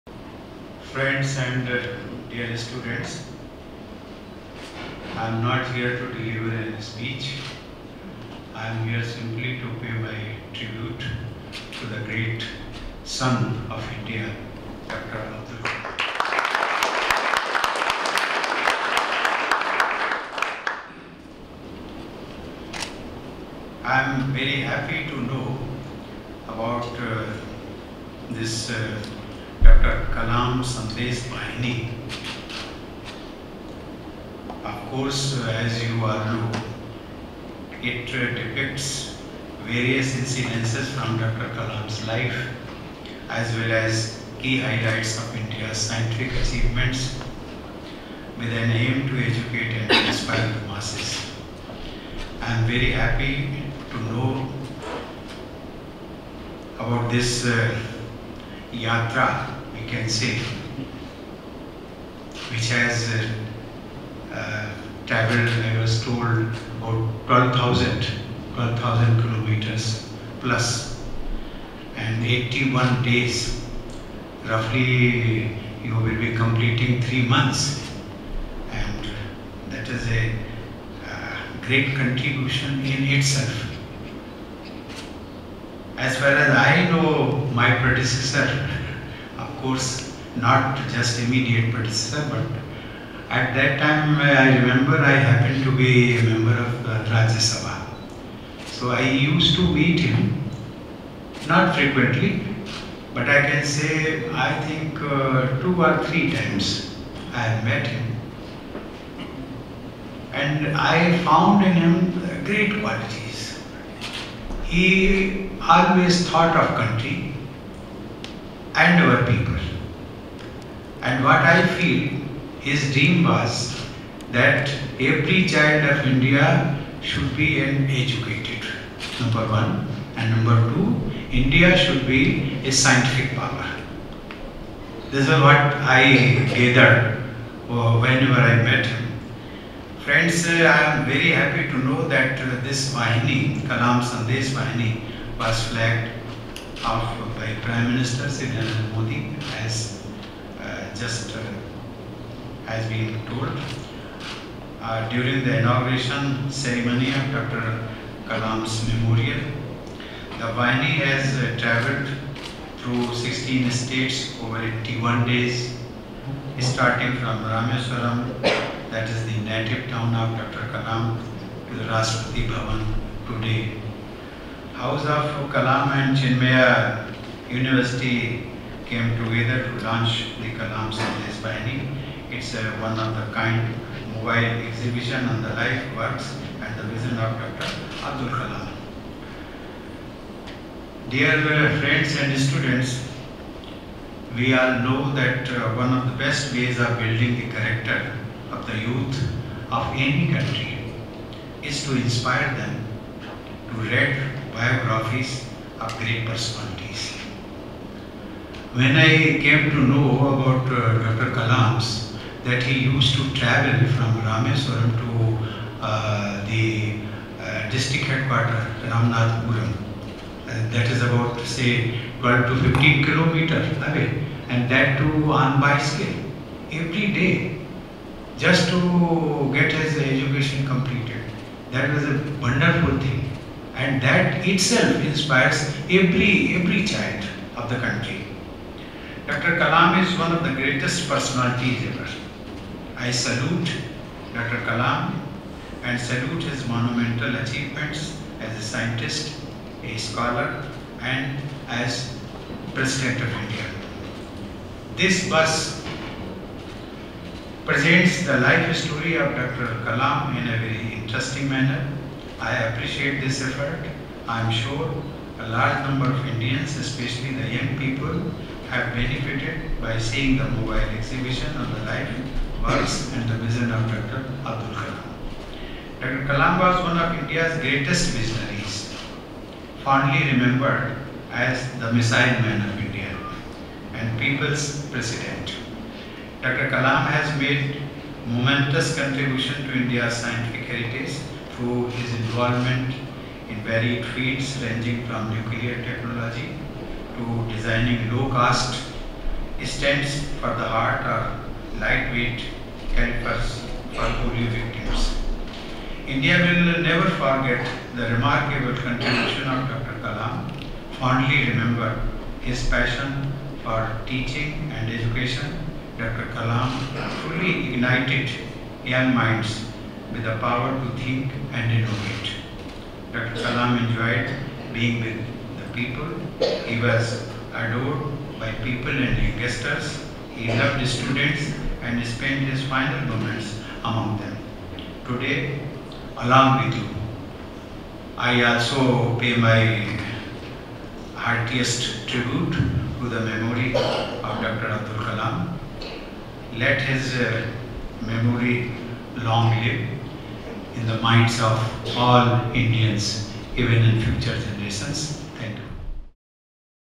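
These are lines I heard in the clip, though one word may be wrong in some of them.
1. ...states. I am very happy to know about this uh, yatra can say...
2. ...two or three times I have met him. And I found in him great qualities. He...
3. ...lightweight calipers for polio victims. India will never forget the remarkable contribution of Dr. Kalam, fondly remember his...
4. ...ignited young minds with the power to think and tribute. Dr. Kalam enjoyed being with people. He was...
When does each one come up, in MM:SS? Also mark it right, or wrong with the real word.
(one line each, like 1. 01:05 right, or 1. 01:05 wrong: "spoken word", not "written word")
1. 00:50 wrong: "masses", not "states"
2. 01:45 right
3. 05:01 right
4. 05:17 wrong: "innovate", not "tribute".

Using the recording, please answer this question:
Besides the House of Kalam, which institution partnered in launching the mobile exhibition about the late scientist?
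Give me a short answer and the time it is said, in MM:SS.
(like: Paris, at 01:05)
Chinmaya University, at 02:56.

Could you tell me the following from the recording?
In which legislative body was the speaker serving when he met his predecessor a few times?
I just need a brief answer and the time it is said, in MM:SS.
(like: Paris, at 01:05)
Rajya Sabha, at 01:37.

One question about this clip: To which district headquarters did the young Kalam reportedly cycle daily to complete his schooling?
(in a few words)
Ramnathpuram.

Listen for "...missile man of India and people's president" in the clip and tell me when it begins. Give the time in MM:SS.
04:41.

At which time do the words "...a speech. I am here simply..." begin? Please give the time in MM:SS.
00:06.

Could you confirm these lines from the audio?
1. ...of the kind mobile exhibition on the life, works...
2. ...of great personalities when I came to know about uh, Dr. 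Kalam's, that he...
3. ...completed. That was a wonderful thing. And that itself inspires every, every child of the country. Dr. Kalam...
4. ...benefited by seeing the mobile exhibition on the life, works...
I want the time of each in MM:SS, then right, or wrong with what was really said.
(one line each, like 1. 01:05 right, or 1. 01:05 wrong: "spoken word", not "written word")
1. 03:02 right
2. 03:25 right
3. 03:50 right
4. 04:28 right.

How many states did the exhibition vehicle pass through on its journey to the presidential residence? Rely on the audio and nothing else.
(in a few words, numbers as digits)
16.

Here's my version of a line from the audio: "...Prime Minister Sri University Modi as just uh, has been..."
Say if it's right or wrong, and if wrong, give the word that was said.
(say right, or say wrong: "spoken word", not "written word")
wrong: "Narendra", not "University".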